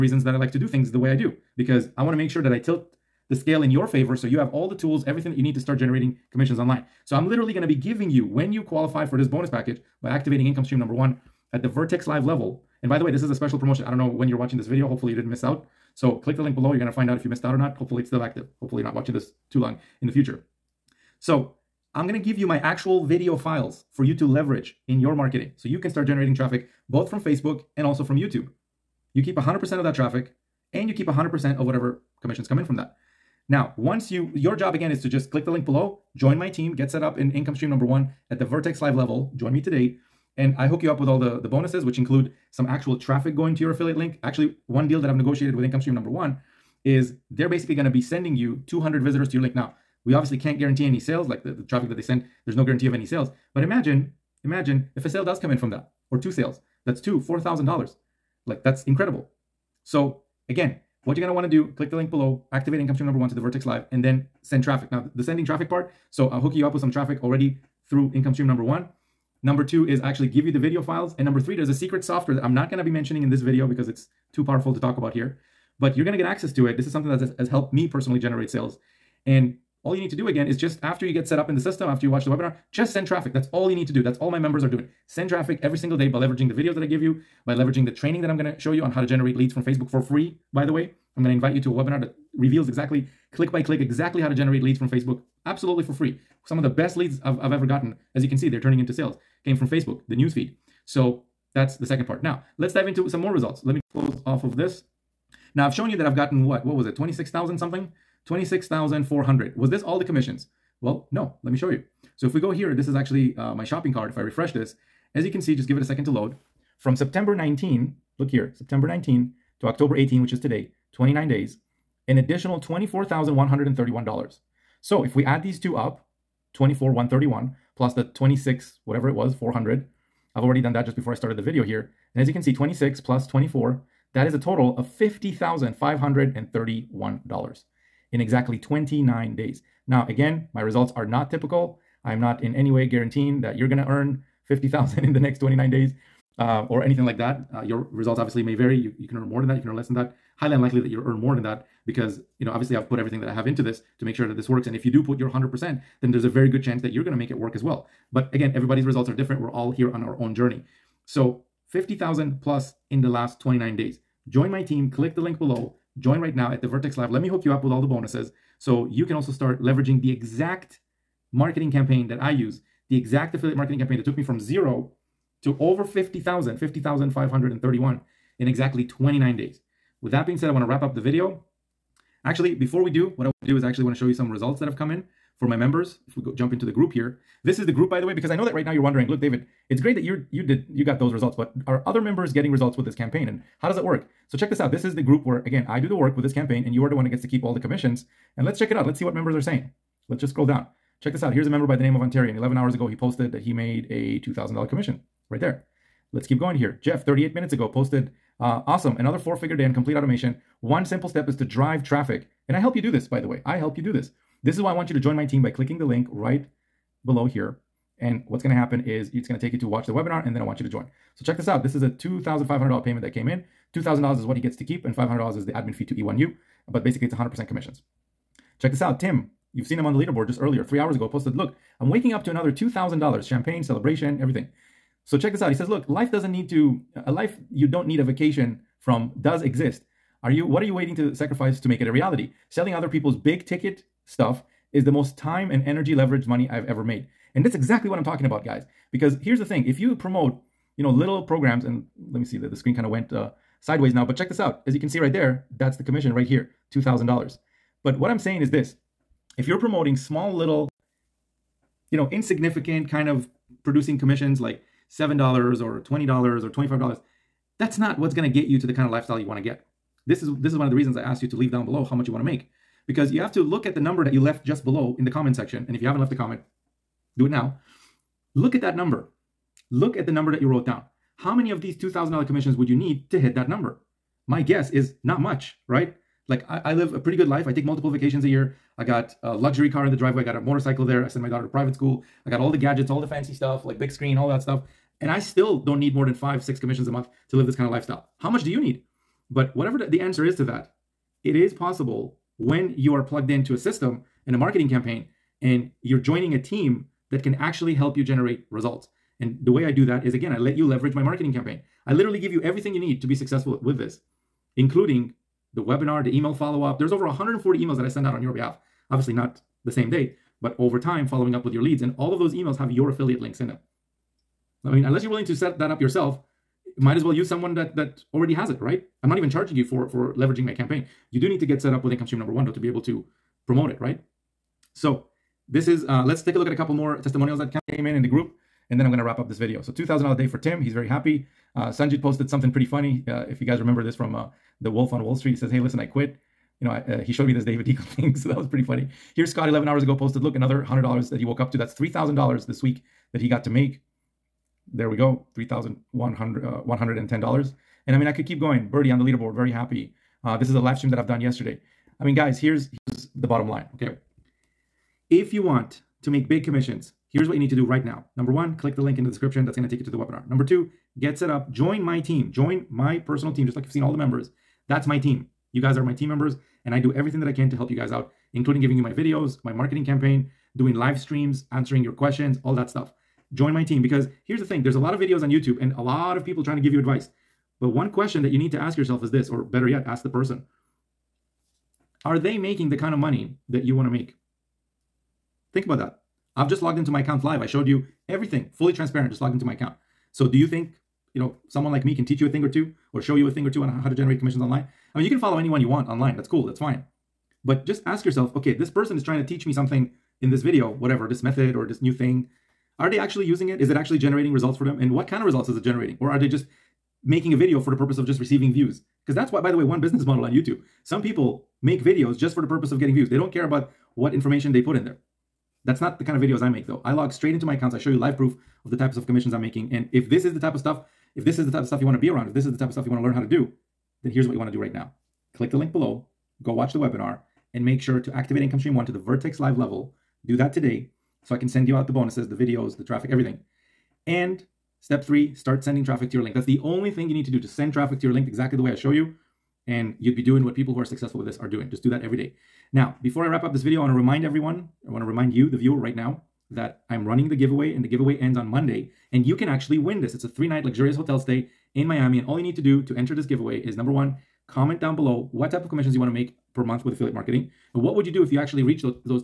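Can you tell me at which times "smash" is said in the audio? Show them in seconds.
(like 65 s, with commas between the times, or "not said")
not said.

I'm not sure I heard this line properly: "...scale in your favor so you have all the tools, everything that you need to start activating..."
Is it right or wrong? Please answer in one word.
wrong.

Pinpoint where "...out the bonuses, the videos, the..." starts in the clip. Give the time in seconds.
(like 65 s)
441 s.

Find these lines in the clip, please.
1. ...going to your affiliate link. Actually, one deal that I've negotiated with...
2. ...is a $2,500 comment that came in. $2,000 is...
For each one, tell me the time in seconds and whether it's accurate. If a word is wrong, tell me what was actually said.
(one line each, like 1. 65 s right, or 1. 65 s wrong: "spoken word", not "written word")
1. 43 s right
2. 221 s wrong: "payment", not "comment".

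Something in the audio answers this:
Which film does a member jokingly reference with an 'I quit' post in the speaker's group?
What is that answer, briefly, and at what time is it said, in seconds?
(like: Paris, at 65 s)
The Wolf on Wall Street, at 344 s.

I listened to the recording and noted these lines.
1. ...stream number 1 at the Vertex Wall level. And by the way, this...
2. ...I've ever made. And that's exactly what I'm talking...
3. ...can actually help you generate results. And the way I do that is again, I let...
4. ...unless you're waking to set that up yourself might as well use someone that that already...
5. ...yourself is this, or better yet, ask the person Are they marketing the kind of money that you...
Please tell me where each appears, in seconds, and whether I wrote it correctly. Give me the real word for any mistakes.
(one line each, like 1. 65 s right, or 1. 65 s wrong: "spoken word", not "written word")
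1. 10 s wrong: "Live", not "Wall"
2. 246 s right
3. 307 s right
4. 324 s wrong: "willing", not "waking"
5. 388 s wrong: "making", not "marketing".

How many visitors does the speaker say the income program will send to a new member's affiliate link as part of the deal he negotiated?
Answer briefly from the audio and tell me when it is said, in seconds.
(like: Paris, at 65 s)
200, at 48 s.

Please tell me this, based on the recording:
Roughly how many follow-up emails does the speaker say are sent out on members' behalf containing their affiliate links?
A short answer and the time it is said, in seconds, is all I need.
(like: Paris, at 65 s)
over 140, at 316 s.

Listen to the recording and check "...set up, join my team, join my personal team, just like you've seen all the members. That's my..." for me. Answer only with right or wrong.
right.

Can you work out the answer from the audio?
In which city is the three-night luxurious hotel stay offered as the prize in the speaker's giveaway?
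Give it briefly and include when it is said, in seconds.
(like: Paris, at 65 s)
Miami, at 461 s.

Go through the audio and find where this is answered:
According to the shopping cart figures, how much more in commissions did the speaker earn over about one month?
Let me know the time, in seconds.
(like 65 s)
122 s.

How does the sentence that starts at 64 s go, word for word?
Now, the sending traffic part, so I'll hook you up with some traffic already through income stream number one.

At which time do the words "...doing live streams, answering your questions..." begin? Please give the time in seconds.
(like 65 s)
380 s.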